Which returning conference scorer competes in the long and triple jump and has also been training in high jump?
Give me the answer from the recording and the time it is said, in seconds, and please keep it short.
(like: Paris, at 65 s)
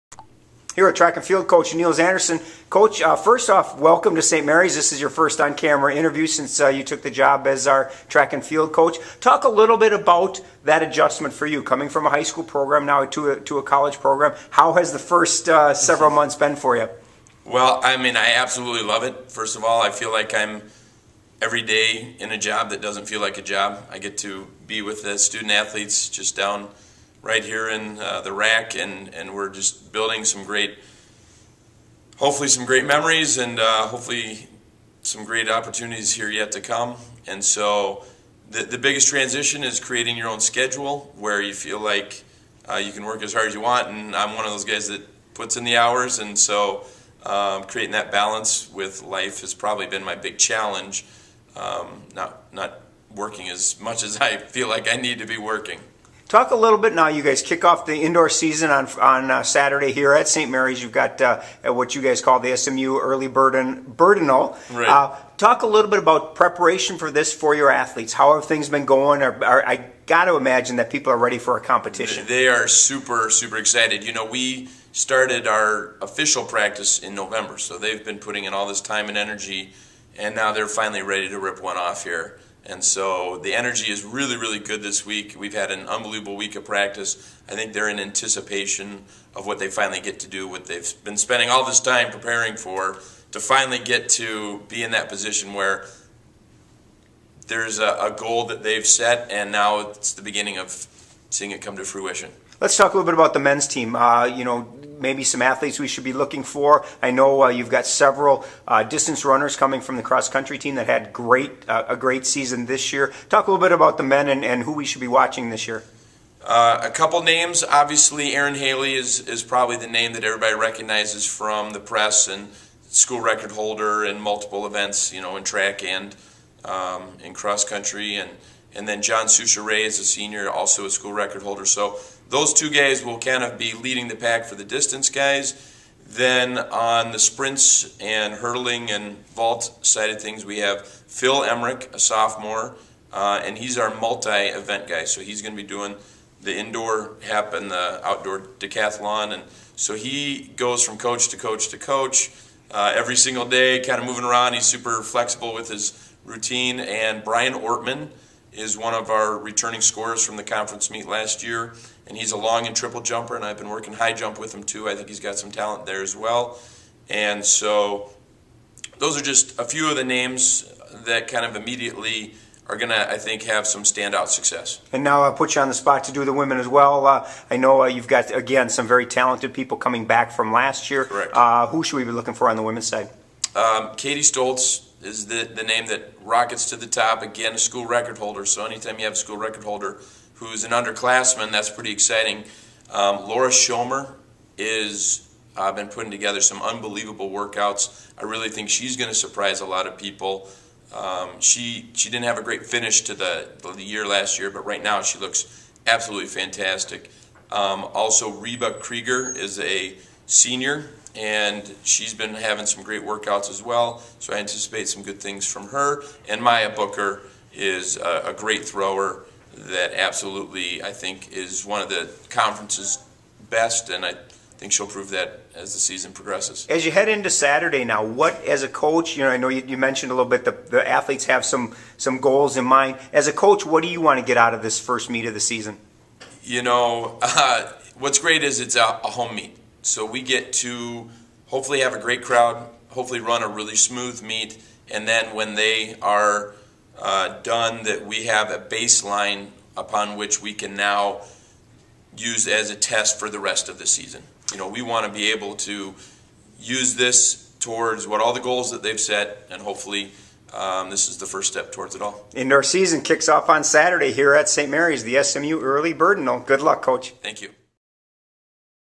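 Brian Ortman, at 157 s.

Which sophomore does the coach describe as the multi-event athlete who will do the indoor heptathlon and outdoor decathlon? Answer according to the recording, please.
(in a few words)
Phil Emmerich.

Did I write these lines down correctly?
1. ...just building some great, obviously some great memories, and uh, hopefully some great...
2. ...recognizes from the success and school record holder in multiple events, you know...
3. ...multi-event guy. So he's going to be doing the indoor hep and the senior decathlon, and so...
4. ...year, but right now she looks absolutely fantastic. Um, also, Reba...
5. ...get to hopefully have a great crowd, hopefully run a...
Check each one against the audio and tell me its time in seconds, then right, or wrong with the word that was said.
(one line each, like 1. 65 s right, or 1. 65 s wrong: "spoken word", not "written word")
1. 29 s wrong: "hopefully", not "obviously"
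2. 120 s wrong: "press", not "success"
3. 143 s wrong: "outdoor", not "senior"
4. 204 s right
5. 240 s right.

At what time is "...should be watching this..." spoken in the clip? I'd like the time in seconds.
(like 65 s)
114 s.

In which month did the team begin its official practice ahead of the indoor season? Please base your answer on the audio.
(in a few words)
November.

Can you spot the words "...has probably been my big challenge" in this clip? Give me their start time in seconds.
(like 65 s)
49 s.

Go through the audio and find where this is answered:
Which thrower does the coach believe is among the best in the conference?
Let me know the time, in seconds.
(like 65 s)
216 s.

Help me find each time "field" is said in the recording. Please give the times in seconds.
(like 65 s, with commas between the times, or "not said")
1 s, 8 s.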